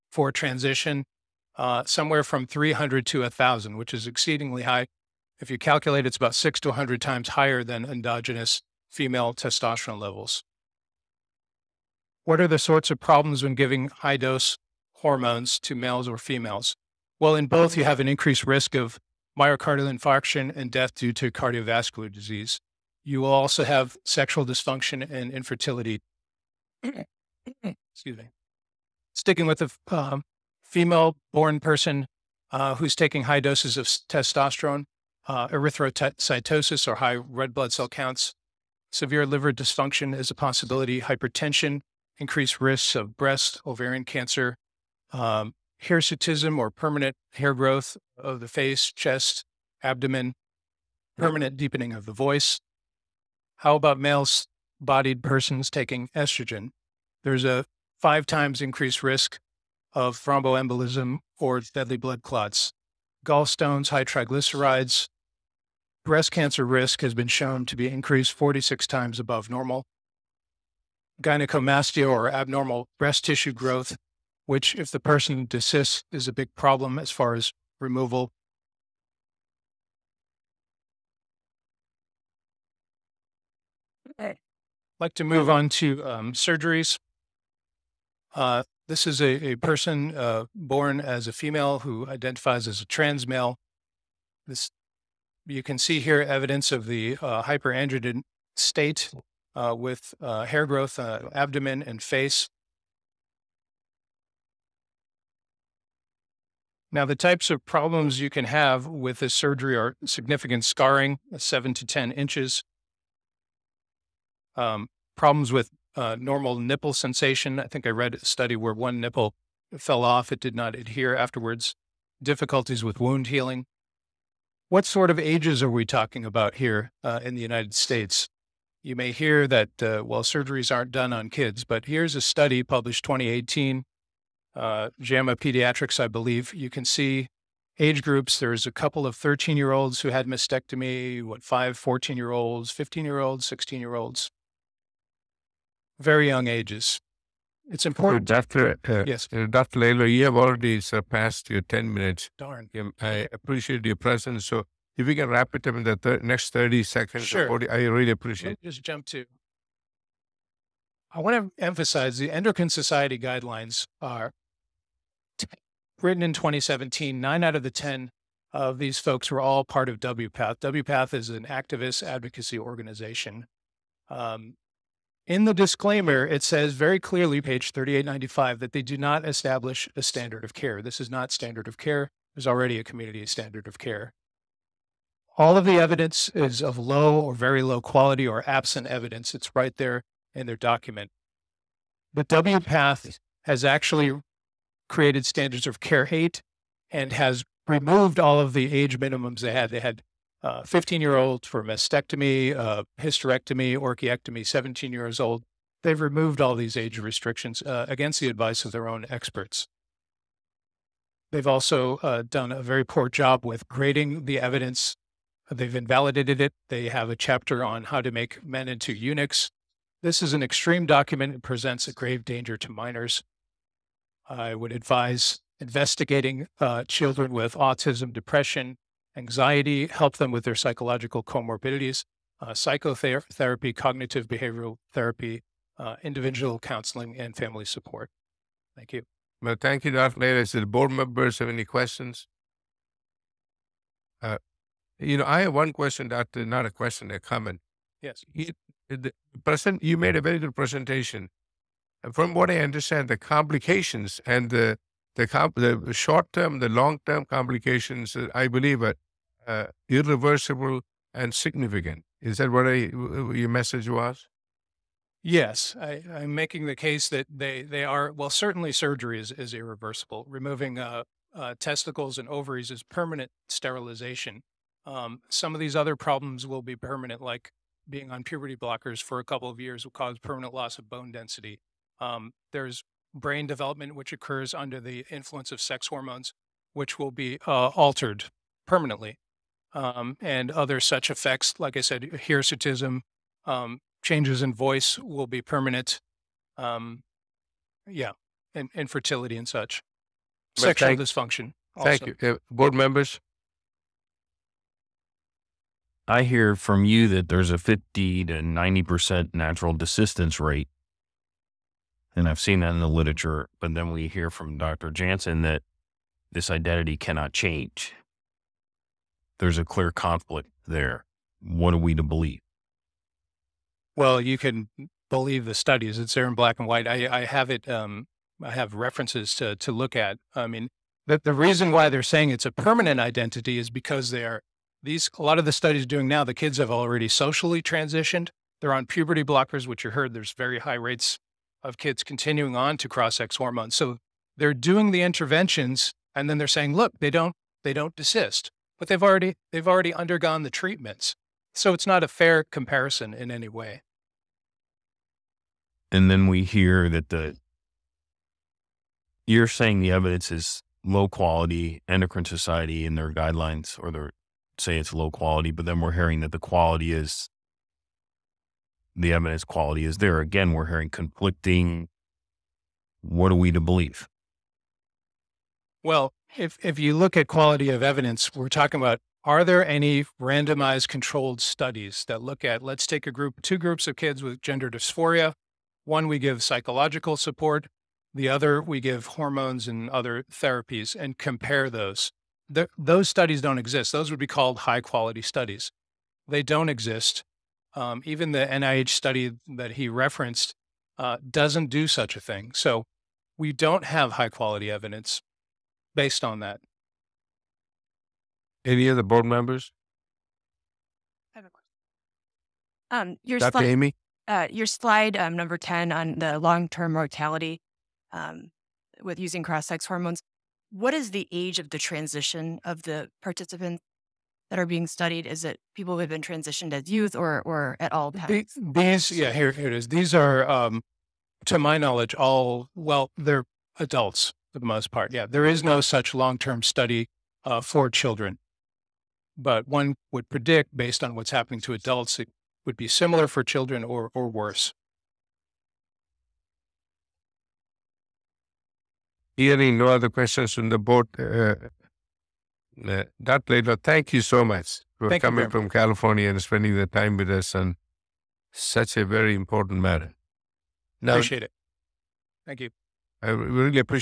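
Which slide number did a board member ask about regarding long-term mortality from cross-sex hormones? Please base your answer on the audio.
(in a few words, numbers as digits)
10.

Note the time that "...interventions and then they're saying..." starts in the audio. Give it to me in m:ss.
5:45.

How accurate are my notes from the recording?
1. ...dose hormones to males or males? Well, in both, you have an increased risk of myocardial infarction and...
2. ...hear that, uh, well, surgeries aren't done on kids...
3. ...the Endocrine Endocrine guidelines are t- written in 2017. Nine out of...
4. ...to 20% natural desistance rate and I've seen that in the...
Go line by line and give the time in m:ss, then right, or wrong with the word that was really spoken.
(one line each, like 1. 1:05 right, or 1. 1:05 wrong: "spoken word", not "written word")
1. 0:14 wrong: "females", not "males"
2. 2:09 right
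3. 2:42 wrong: "Society", not "Endocrine"
4. 5:08 wrong: "90", not "20".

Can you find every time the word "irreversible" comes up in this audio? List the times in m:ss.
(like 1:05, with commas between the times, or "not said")
4:19, 4:29.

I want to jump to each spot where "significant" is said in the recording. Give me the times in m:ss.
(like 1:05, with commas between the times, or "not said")
1:50, 4:21.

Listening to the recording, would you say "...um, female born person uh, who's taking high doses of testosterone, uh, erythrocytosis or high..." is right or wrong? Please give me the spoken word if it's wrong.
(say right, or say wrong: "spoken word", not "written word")
right.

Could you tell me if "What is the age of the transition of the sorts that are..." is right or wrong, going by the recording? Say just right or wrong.
wrong.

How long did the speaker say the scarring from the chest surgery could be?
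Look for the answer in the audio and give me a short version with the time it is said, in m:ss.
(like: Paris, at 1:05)
7 to 10 inches, at 1:51.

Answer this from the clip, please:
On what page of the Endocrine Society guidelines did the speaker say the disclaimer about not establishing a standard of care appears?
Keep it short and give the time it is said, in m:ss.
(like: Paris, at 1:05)
3895, at 2:57.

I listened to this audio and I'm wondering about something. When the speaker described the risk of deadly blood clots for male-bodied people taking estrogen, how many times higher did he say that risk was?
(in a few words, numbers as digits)
5 times.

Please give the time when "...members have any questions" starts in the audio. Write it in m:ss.
4:00.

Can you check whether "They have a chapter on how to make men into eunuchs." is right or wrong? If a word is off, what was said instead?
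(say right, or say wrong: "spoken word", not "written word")
right.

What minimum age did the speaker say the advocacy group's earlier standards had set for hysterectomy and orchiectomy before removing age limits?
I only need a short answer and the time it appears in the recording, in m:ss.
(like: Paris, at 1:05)
17, at 3:24.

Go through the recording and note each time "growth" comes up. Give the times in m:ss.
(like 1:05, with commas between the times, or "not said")
0:47, 1:13, 1:40.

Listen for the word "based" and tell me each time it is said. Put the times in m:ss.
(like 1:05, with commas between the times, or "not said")
6:45, 7:20.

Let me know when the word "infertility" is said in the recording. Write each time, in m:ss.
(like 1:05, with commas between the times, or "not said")
0:25, 4:58.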